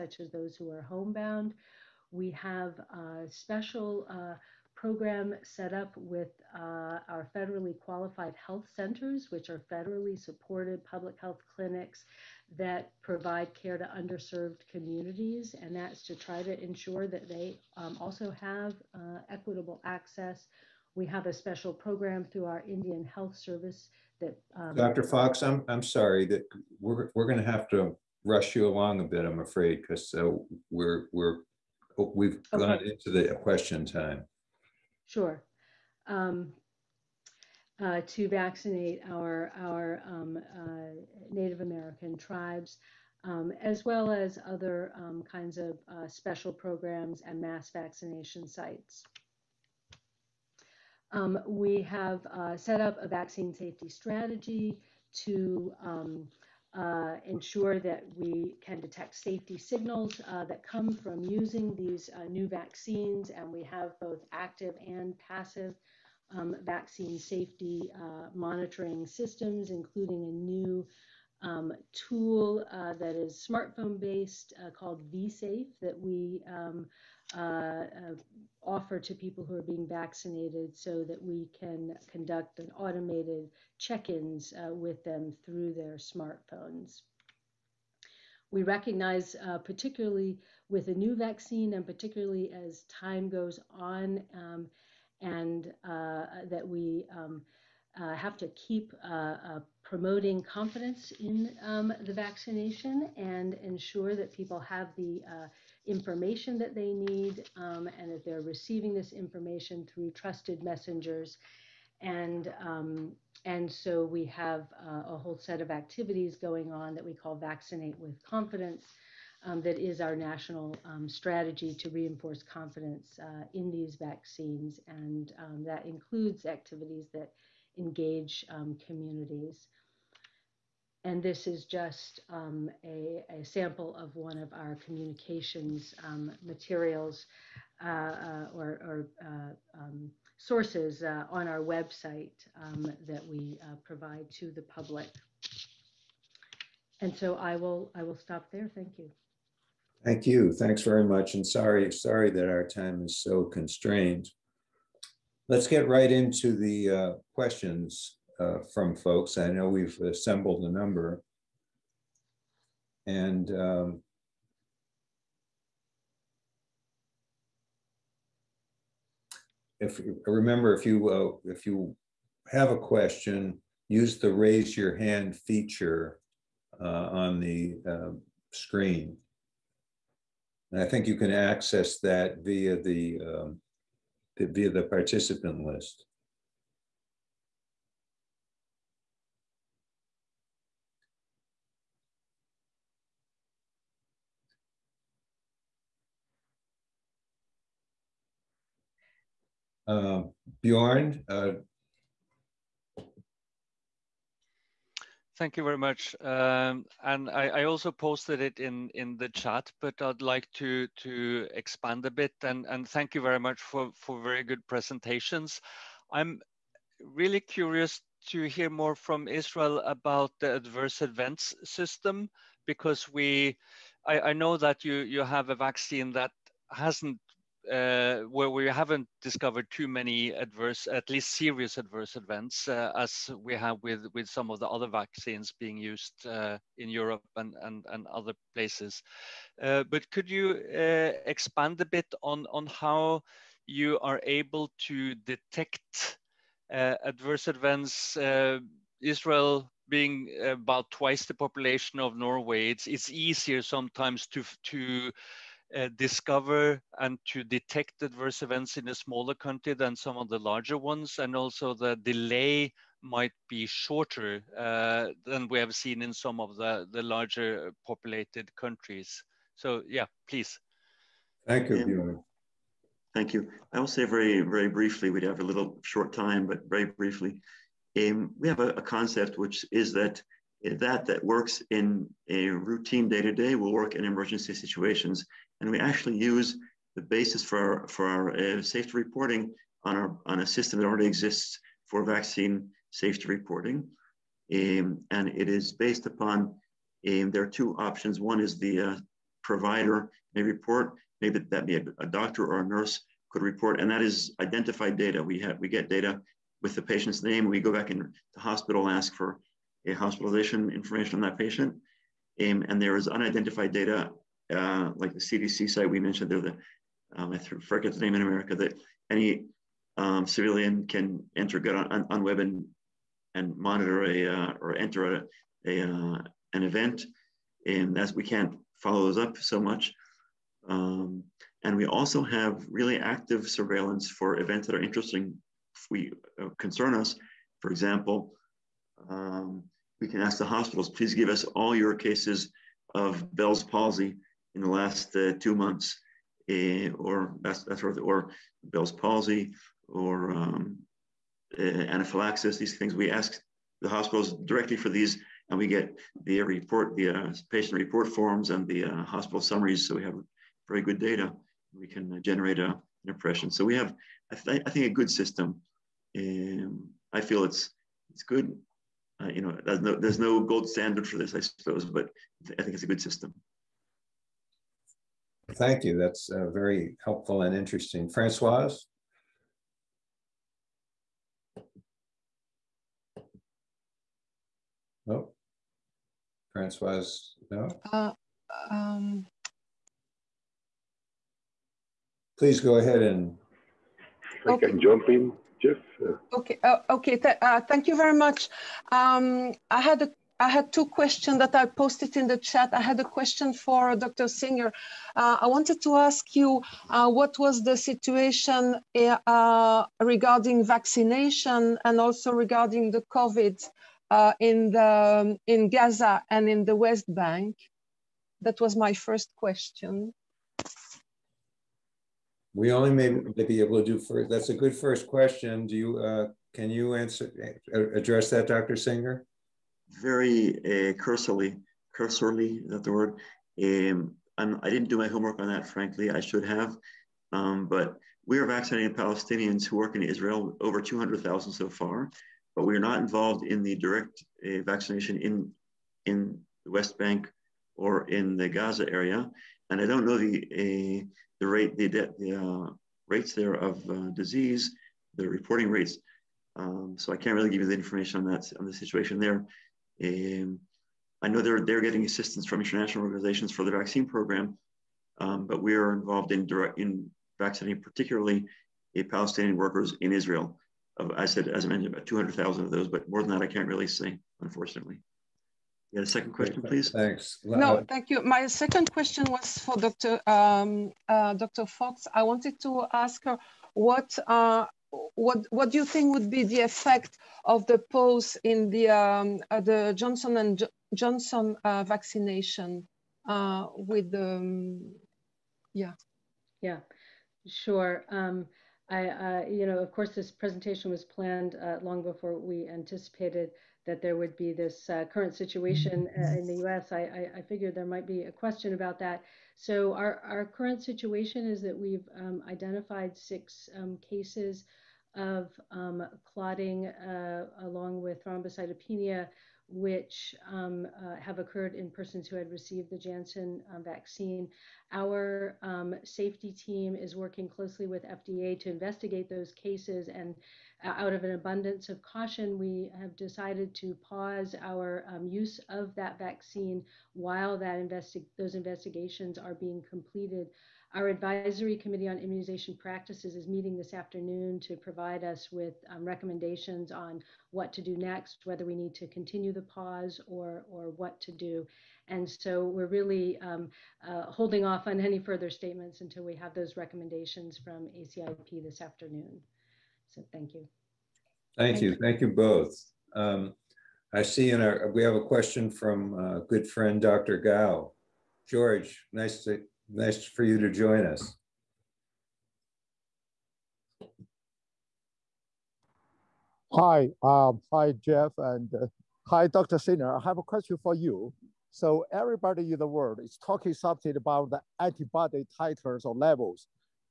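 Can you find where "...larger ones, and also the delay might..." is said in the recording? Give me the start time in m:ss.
4:20.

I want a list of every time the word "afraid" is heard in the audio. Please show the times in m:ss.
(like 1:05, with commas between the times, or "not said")
0:29.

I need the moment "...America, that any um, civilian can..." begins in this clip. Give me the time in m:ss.
5:18.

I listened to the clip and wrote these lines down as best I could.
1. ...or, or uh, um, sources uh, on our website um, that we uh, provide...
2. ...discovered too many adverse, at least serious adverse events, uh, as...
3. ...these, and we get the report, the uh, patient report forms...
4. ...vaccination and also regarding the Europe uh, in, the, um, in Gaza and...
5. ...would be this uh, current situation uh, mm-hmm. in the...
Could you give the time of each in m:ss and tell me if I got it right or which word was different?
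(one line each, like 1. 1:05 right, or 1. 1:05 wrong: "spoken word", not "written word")
1. 2:18 right
2. 3:49 right
3. 5:54 right
4. 6:50 wrong: "COVID", not "Europe"
5. 8:24 right.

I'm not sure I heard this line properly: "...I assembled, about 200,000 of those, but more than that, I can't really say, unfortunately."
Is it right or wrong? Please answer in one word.
wrong.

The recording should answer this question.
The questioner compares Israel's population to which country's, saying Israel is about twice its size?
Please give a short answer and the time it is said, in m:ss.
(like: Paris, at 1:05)
Norway, at 4:12.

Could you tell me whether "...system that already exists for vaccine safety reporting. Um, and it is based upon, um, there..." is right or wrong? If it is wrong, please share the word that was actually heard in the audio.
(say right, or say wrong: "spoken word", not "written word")
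right.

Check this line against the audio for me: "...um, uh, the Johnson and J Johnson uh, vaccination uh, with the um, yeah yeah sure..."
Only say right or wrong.
right.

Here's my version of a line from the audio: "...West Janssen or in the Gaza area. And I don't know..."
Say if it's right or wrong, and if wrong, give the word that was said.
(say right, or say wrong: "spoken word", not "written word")
wrong: "Bank", not "Janssen".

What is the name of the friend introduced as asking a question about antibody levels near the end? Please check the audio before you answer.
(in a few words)
Dr. Gao.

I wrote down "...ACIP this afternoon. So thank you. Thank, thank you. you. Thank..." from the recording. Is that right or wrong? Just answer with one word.
right.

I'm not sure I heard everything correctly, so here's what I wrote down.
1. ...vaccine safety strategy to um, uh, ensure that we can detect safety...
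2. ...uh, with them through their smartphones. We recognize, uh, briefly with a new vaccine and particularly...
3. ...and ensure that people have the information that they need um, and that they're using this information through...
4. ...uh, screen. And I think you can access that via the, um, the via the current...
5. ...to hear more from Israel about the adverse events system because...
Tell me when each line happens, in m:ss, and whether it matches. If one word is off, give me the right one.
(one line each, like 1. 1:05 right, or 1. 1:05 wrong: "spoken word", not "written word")
1. 0:53 right
2. 1:24 wrong: "particularly", not "briefly"
3. 1:43 wrong: "receiving", not "using"
4. 2:57 wrong: "participant", not "current"
5. 3:38 right.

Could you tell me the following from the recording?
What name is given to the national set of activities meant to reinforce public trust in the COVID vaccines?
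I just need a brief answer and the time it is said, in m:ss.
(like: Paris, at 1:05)
Vaccinate with Confidence, at 1:57.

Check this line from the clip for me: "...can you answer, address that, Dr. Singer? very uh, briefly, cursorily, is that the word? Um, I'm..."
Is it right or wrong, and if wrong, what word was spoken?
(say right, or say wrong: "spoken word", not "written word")
wrong: "cursorily", not "briefly".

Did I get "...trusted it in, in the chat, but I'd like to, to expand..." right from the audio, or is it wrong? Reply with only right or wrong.
wrong.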